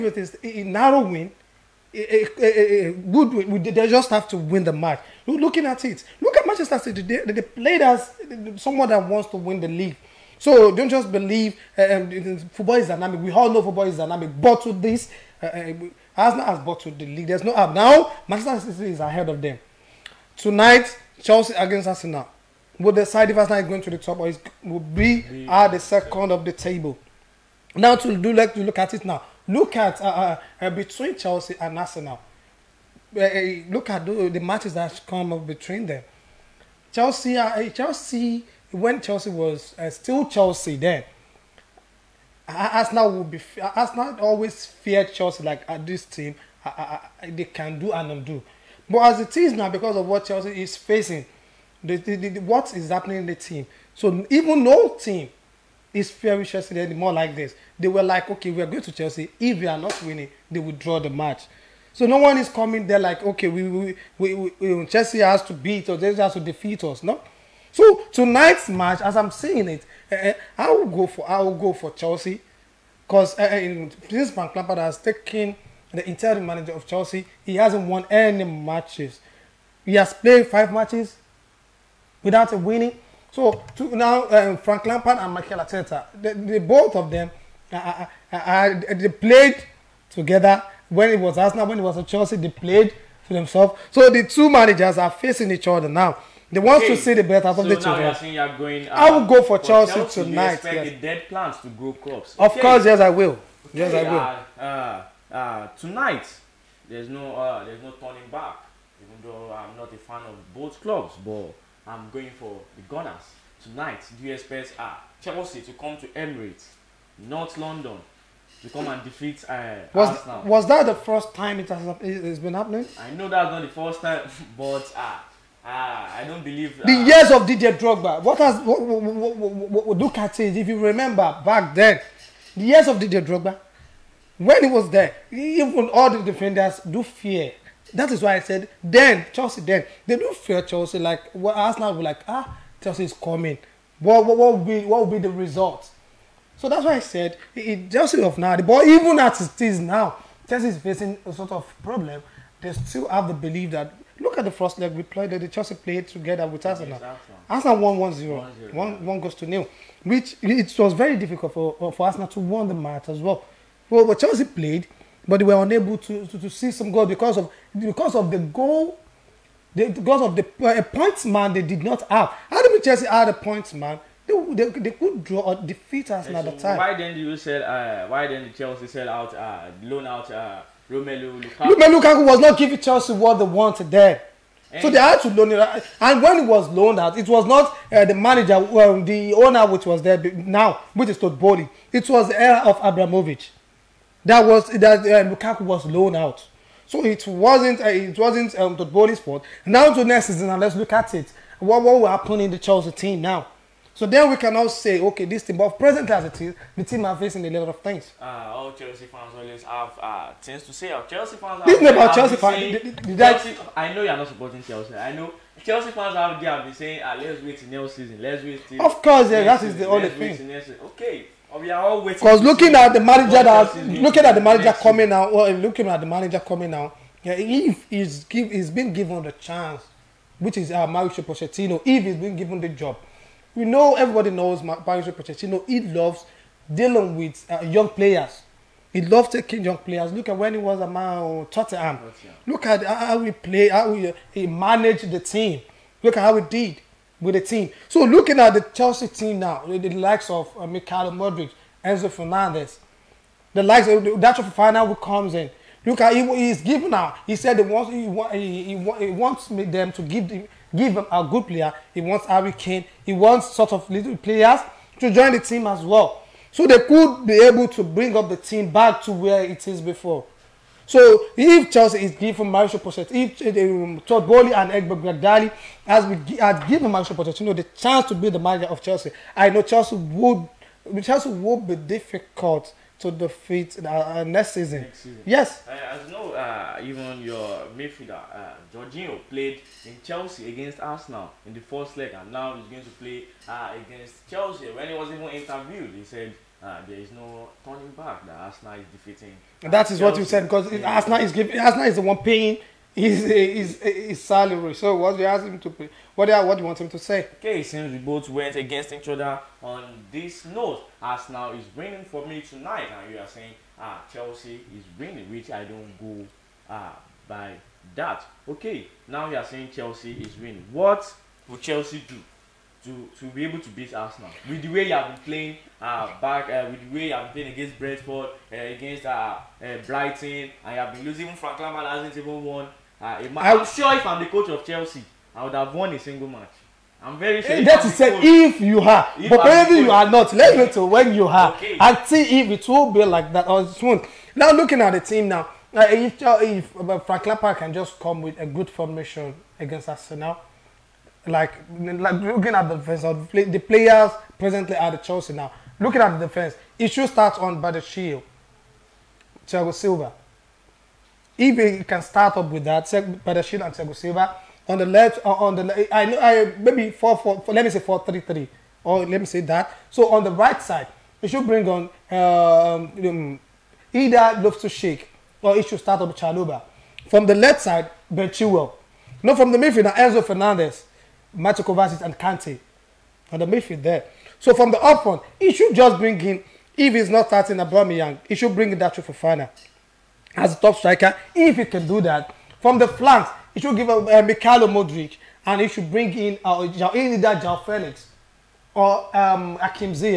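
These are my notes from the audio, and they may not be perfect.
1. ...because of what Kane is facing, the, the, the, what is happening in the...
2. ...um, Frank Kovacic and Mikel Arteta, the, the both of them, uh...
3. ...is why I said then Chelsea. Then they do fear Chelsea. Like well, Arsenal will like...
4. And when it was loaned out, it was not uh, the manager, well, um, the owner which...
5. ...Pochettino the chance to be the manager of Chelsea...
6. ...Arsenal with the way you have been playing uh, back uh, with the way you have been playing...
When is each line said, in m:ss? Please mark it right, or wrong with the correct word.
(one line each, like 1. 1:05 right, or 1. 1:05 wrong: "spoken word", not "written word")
1. 0:49 wrong: "Chelsea", not "Kane"
2. 1:24 wrong: "Lampard", not "Kovacic"
3. 2:18 right
4. 3:05 right
5. 4:37 right
6. 5:23 right.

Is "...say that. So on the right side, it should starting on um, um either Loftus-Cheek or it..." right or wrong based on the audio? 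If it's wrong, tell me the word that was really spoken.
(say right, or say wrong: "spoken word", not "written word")
wrong: "bring", not "starting".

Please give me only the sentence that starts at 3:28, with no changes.
Uh, all Chelsea fans always have uh, things to say.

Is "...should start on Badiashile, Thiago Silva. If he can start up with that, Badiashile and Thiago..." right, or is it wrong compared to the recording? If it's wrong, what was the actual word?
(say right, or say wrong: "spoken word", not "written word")
right.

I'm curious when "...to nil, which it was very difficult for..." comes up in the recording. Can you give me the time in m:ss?
2:39.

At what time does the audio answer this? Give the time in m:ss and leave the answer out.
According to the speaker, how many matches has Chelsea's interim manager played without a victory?
1:20.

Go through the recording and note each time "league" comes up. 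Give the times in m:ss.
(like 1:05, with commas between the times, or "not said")
0:09, 0:17.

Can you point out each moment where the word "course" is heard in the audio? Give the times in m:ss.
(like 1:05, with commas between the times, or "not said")
1:42, 3:39.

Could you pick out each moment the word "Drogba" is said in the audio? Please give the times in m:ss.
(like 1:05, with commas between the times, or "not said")
2:07, 2:13.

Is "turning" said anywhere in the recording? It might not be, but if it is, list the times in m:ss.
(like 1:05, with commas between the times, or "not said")
1:47, 4:57.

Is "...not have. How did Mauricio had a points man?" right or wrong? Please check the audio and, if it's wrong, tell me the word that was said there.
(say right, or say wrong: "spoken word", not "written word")
wrong: "Chelsea", not "Mauricio".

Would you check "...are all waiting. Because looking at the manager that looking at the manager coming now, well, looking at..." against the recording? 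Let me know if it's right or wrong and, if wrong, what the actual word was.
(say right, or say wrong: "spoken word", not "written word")
right.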